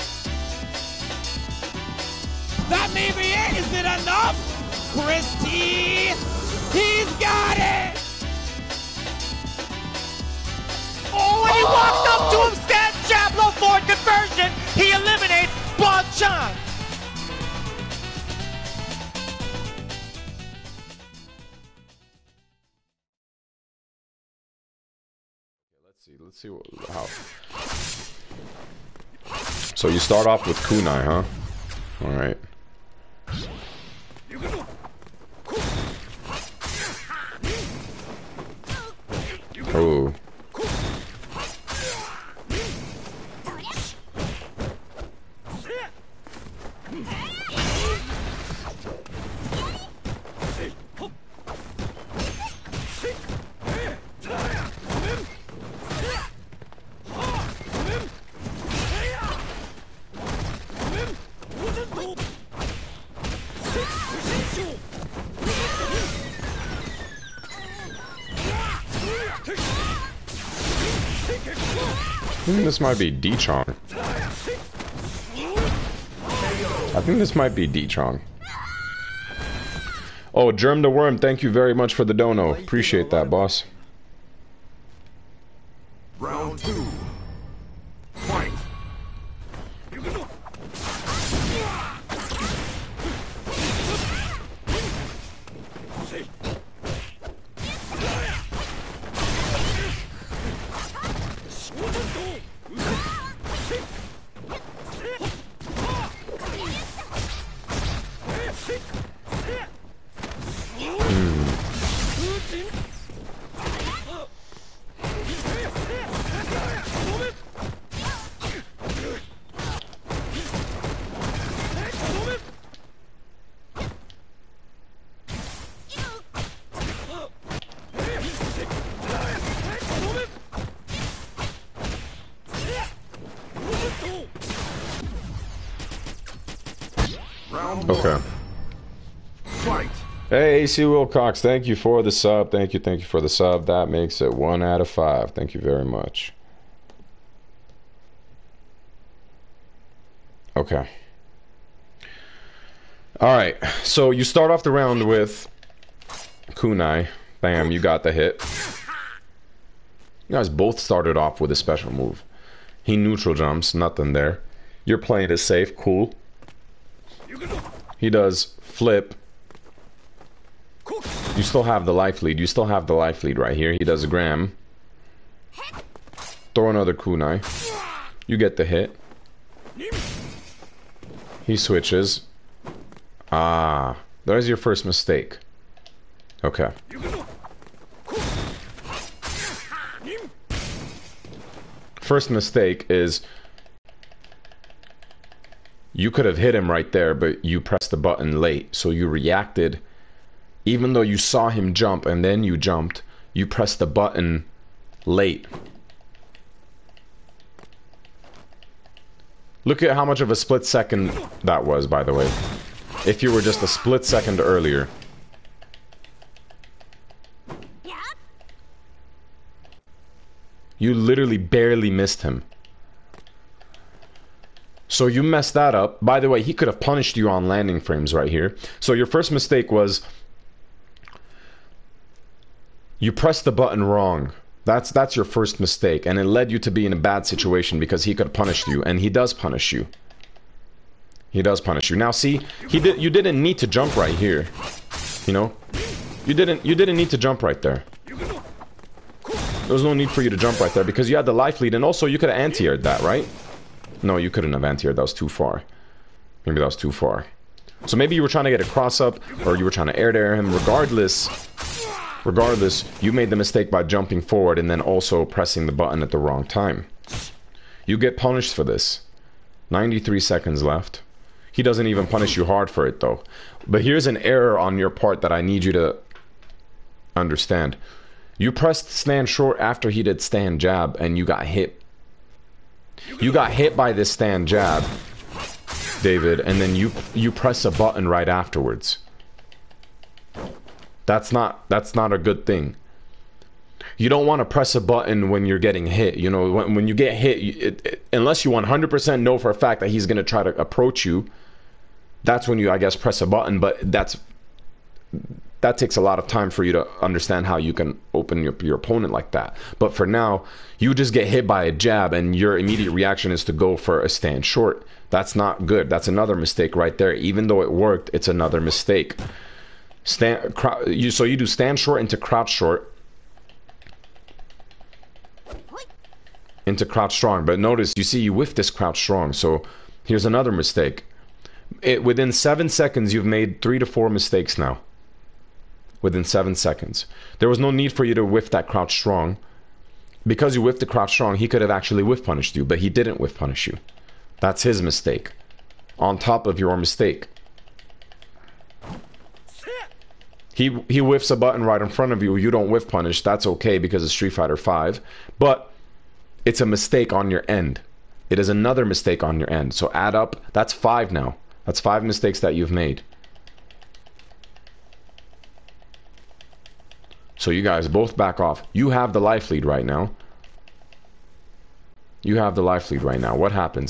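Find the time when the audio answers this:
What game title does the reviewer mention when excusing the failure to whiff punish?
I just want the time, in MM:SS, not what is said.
05:54.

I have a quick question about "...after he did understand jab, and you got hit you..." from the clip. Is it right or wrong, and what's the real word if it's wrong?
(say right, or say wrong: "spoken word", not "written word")
wrong: "stand", not "understand".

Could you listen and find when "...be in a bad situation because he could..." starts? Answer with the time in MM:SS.
03:56.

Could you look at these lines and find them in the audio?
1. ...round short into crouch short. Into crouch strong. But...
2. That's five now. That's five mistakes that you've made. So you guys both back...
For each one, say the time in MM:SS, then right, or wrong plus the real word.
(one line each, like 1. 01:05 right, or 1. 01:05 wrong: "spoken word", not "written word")
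1. 05:21 wrong: "stand", not "round"
2. 06:00 right.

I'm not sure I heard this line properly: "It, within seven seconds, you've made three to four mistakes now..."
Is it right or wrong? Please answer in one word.
right.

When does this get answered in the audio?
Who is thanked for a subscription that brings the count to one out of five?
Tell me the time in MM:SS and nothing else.
02:20.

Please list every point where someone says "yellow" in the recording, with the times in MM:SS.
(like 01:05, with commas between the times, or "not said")
not said.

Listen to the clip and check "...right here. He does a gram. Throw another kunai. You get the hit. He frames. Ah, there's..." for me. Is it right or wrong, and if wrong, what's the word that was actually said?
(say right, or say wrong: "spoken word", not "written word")
wrong: "switches", not "frames".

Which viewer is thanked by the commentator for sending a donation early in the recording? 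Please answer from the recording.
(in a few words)
Germ the Worm.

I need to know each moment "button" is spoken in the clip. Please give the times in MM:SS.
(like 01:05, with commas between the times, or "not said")
03:17, 03:23, 03:53, 04:25, 04:47, 04:54, 05:03, 05:51.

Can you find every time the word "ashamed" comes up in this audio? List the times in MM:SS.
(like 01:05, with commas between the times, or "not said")
not said.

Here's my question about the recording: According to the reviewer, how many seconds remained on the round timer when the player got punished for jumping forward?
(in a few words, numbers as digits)
93.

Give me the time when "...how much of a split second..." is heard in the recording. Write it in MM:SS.
03:29.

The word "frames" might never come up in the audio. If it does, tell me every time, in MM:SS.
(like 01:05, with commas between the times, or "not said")
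03:47.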